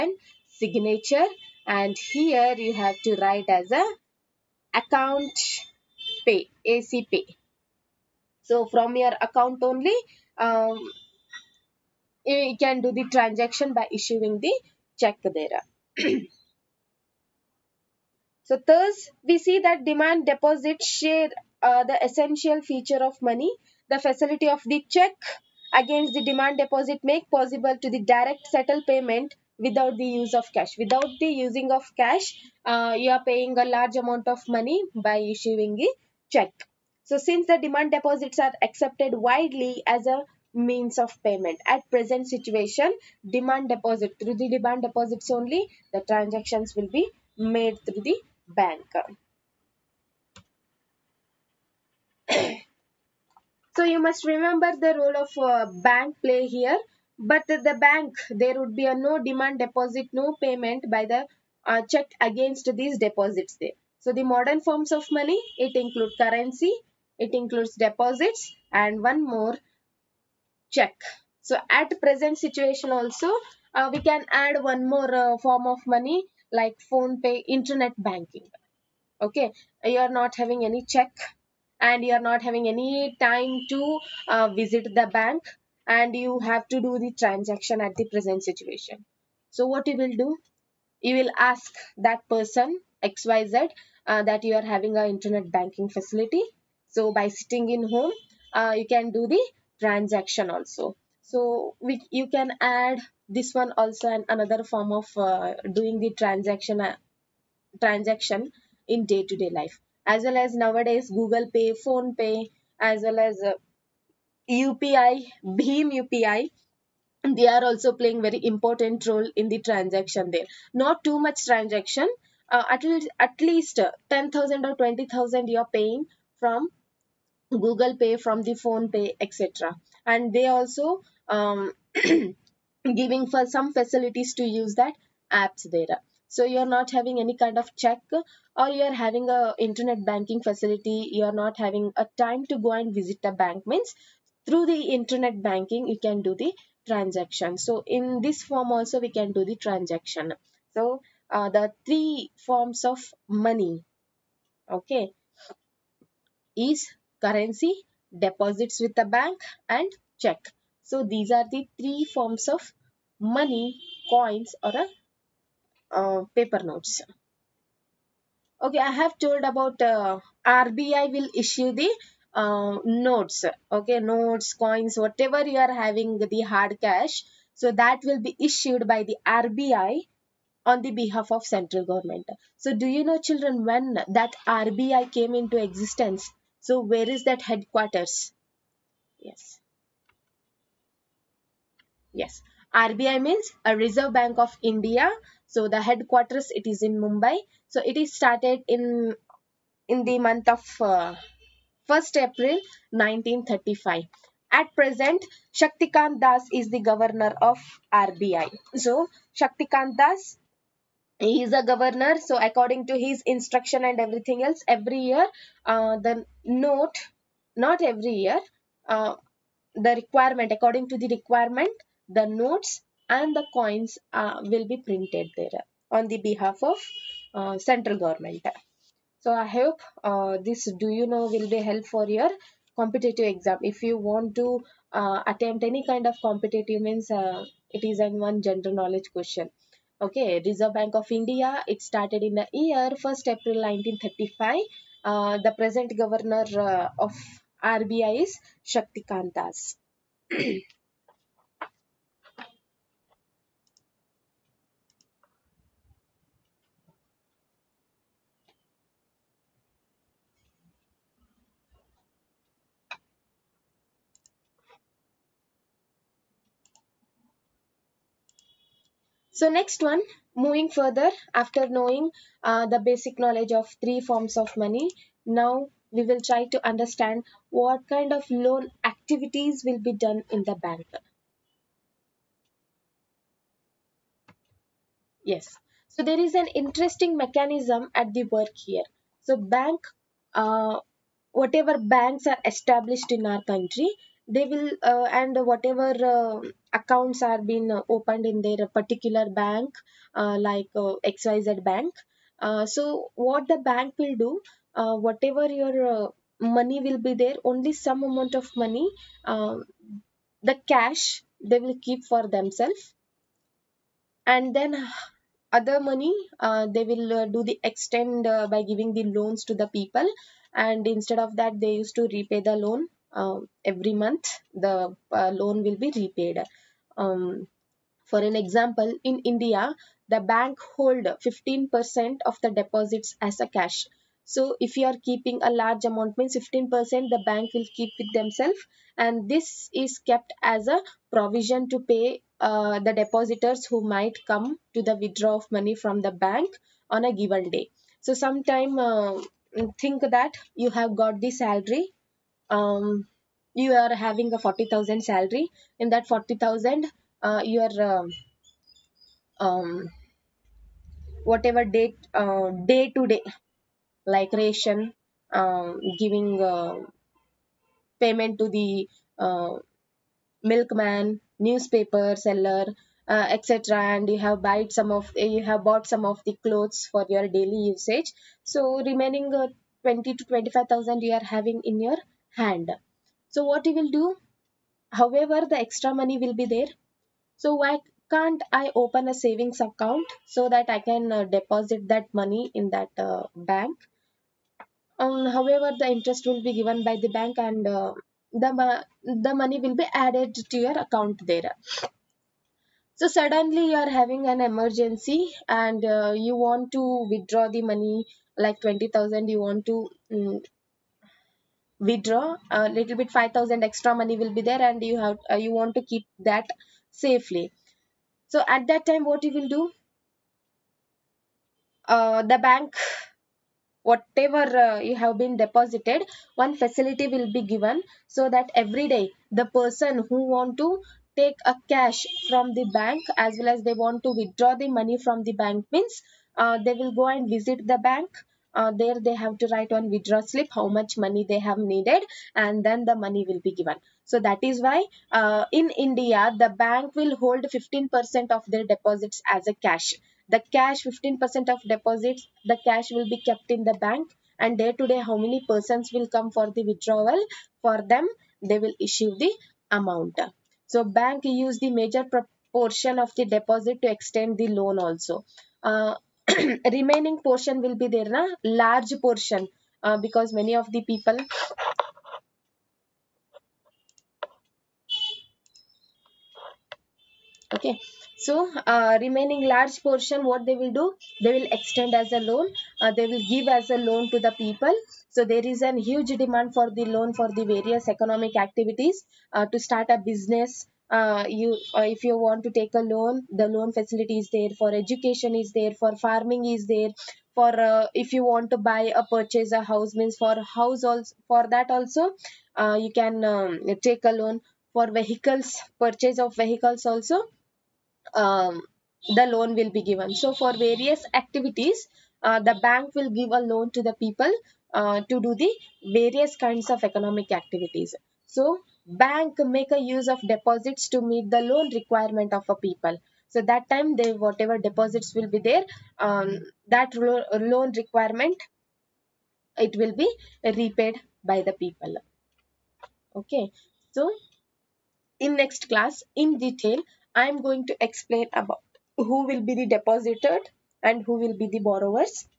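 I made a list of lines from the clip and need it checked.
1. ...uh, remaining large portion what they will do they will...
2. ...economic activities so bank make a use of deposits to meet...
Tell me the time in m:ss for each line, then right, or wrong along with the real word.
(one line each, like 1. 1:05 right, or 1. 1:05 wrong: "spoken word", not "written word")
1. 7:58 right
2. 8:36 right.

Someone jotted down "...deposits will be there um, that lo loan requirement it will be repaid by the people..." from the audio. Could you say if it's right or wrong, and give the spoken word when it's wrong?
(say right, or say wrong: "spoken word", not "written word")
right.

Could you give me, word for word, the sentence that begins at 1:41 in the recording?
So we, you can add this one also and another form of uh, doing the transaction uh, transaction in day-to-day -day life.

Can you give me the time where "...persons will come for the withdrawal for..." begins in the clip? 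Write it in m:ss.
7:35.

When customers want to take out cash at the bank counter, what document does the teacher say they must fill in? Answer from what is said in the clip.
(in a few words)
Withdraw slip.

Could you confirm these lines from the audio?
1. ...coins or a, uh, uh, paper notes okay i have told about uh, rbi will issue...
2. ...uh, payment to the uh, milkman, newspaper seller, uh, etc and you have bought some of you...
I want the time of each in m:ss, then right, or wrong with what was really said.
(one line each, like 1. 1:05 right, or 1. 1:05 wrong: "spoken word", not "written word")
1. 2:44 right
2. 6:06 right.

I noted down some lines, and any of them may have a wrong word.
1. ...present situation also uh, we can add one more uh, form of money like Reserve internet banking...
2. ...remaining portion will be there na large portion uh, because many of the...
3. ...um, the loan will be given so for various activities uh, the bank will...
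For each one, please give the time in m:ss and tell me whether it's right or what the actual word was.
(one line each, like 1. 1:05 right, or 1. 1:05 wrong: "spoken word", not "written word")
1. 1:12 wrong: "PhonePe", not "Reserve"
2. 7:46 right
3. 8:28 right.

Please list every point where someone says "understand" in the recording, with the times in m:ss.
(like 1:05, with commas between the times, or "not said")
4:36.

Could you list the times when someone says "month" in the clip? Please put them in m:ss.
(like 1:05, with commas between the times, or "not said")
3:20, 5:23.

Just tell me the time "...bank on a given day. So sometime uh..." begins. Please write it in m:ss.
5:46.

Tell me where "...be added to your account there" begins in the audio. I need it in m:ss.
6:39.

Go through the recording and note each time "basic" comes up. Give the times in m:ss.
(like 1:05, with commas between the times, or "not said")
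4:32.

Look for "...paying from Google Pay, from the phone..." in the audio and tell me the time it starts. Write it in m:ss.
2:05.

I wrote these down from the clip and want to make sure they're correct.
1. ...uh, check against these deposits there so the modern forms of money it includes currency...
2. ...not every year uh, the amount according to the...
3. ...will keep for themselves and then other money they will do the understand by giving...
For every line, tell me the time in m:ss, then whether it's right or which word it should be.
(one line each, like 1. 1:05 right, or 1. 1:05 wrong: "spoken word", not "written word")
1. 1:01 right
2. 3:37 wrong: "requirement", not "amount"
3. 5:11 wrong: "extend", not "understand".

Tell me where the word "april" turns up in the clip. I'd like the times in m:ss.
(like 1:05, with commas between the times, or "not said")
3:22, 4:03.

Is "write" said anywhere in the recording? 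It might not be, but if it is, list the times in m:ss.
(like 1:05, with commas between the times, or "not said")
0:03, 7:19.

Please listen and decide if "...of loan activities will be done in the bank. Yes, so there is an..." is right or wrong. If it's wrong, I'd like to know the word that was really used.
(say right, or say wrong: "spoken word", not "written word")
right.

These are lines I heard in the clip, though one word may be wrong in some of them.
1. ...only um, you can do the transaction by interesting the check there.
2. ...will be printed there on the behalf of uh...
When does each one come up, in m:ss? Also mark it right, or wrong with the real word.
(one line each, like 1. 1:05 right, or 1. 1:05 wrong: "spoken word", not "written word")
1. 0:09 wrong: "issuing", not "interesting"
2. 3:44 right.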